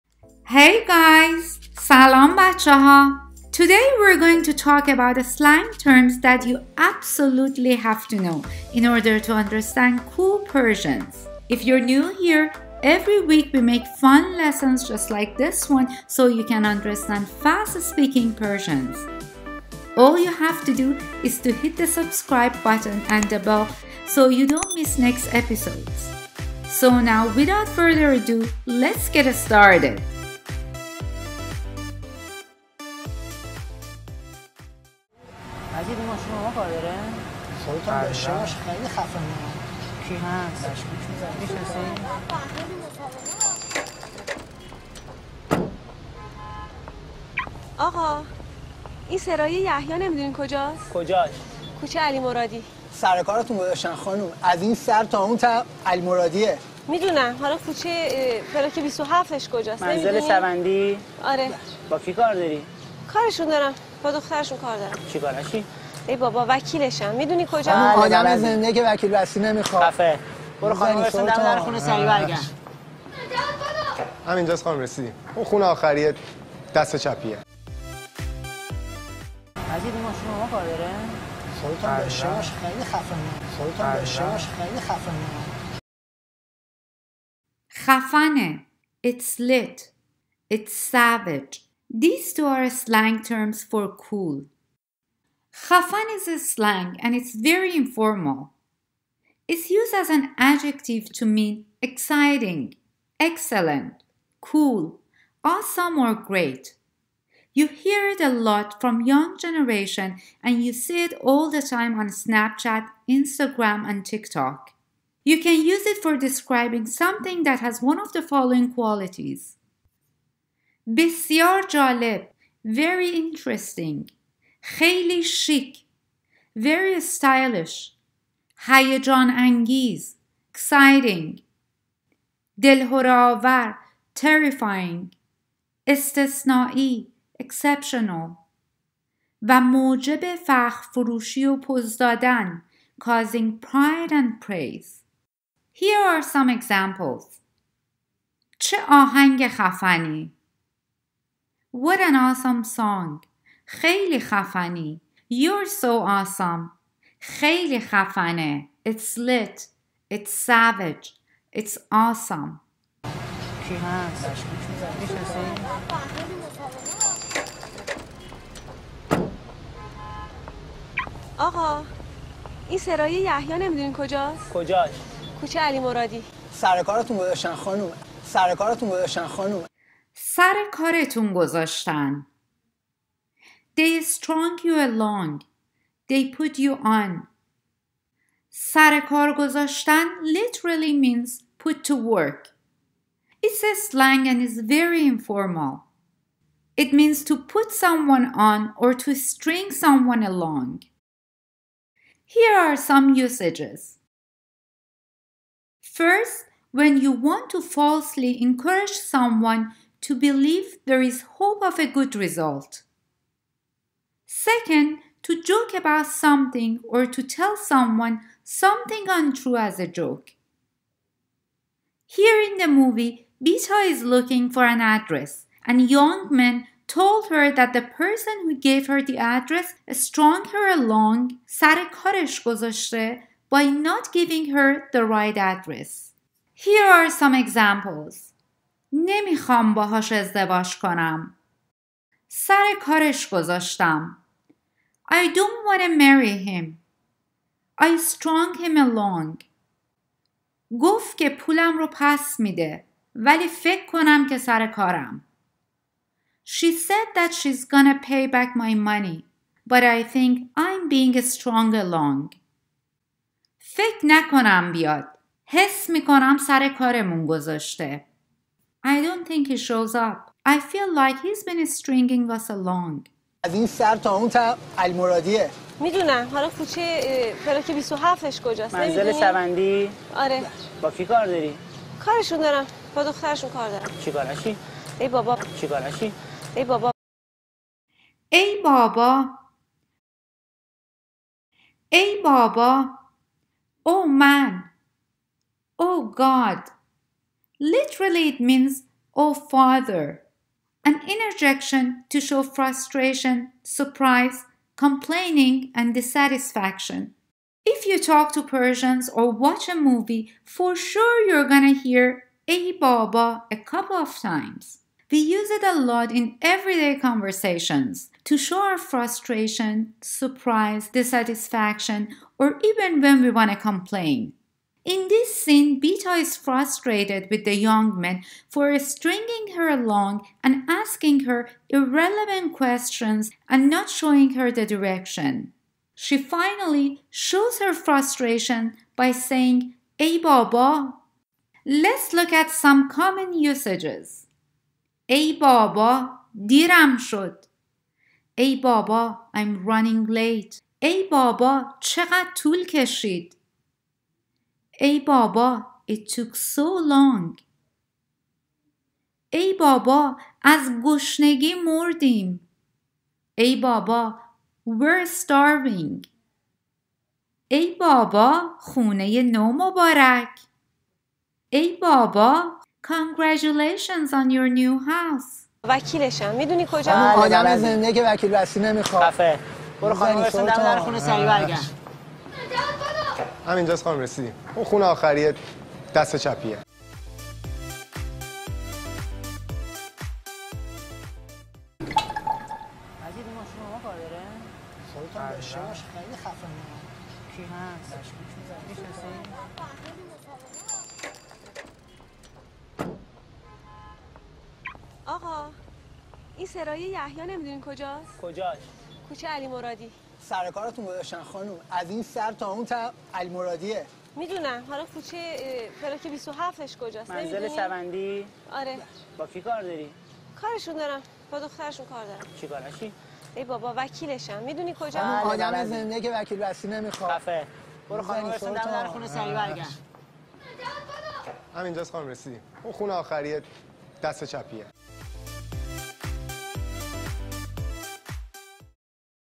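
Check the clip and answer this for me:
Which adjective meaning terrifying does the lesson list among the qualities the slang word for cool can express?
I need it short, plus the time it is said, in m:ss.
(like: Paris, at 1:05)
دلهوراور, at 2:12.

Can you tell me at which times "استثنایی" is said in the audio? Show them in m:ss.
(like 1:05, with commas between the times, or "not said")
2:15.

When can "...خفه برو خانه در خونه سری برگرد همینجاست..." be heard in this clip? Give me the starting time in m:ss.
6:19.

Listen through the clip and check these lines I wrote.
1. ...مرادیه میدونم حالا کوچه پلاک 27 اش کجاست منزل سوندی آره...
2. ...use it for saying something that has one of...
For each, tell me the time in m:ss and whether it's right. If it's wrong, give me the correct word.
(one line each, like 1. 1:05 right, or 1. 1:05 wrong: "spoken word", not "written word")
1. 0:56 right
2. 1:55 wrong: "describing", not "saying".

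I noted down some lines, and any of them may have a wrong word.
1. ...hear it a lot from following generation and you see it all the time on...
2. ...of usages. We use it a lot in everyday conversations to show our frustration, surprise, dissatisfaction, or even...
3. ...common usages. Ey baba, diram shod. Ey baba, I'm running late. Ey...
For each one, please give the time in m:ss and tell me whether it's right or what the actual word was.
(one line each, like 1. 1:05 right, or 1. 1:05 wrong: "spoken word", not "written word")
1. 1:47 wrong: "young", not "following"
2. 5:13 wrong: "times", not "usages"
3. 5:42 right.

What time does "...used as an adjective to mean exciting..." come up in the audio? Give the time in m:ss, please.
1:39.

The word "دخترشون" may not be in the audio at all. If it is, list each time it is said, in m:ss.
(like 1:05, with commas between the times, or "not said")
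1:04, 4:43, 7:01.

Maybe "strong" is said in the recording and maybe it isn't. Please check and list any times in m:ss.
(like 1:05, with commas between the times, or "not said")
4:07, 4:21.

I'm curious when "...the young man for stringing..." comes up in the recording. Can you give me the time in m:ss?
5:27.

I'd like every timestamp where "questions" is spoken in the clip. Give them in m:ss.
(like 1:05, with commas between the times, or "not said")
5:32.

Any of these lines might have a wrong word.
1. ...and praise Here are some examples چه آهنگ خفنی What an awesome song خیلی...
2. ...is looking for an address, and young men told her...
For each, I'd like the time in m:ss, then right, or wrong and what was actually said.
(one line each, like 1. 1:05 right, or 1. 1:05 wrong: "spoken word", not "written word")
1. 2:24 right
2. 3:43 right.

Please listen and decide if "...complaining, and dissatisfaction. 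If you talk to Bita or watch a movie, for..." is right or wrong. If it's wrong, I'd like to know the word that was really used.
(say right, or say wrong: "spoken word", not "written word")
wrong: "Persians", not "Bita".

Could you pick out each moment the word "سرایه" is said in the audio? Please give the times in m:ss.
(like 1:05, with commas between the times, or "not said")
0:49, 2:52, 6:46.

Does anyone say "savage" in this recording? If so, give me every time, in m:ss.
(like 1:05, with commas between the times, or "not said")
1:30, 2:40.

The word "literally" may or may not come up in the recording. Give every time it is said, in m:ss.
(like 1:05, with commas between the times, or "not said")
3:10, 4:57.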